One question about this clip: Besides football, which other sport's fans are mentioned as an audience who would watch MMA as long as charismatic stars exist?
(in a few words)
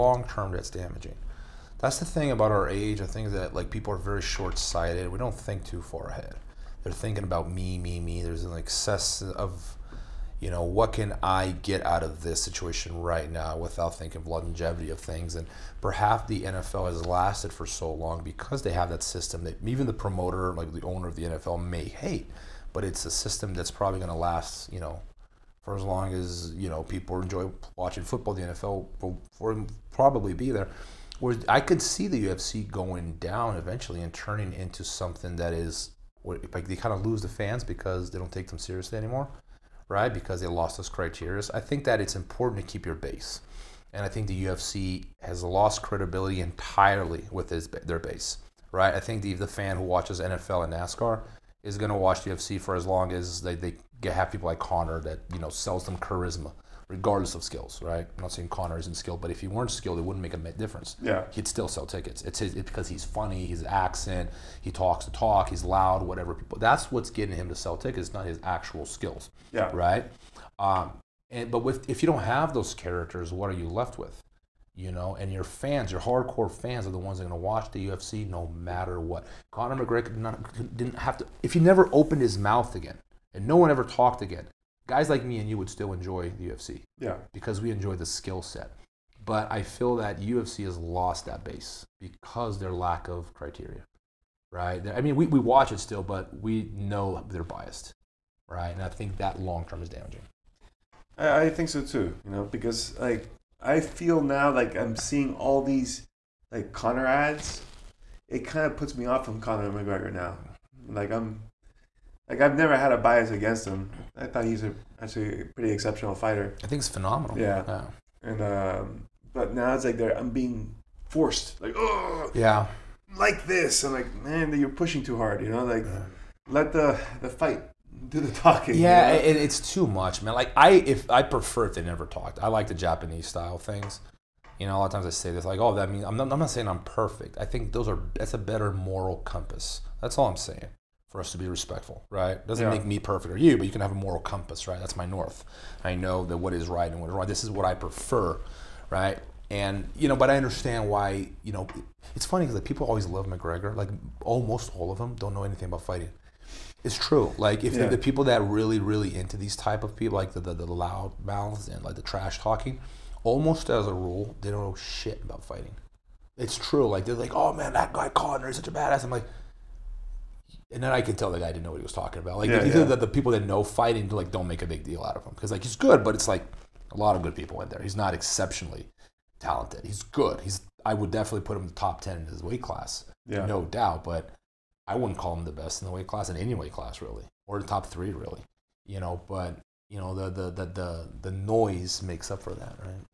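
NASCAR.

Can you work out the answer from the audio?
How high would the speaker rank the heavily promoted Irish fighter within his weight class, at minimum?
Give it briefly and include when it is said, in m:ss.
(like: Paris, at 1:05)
top ten, at 3:01.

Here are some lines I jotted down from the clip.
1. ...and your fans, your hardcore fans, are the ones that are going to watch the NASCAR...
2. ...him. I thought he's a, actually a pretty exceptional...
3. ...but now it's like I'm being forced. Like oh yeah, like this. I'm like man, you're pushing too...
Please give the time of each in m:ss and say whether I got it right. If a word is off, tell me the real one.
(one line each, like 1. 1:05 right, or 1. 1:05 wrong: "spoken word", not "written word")
1. 1:15 wrong: "UFC", not "NASCAR"
2. 1:53 right
3. 1:59 right.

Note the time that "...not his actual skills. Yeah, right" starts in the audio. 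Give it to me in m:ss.
1:08.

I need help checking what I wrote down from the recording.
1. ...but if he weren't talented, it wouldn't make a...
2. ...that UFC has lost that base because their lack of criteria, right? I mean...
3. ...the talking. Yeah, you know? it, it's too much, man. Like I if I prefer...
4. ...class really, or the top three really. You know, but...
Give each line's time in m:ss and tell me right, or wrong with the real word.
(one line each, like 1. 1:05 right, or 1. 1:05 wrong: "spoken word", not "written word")
1. 0:59 wrong: "skilled", not "talented"
2. 1:29 right
3. 2:08 right
4. 3:06 right.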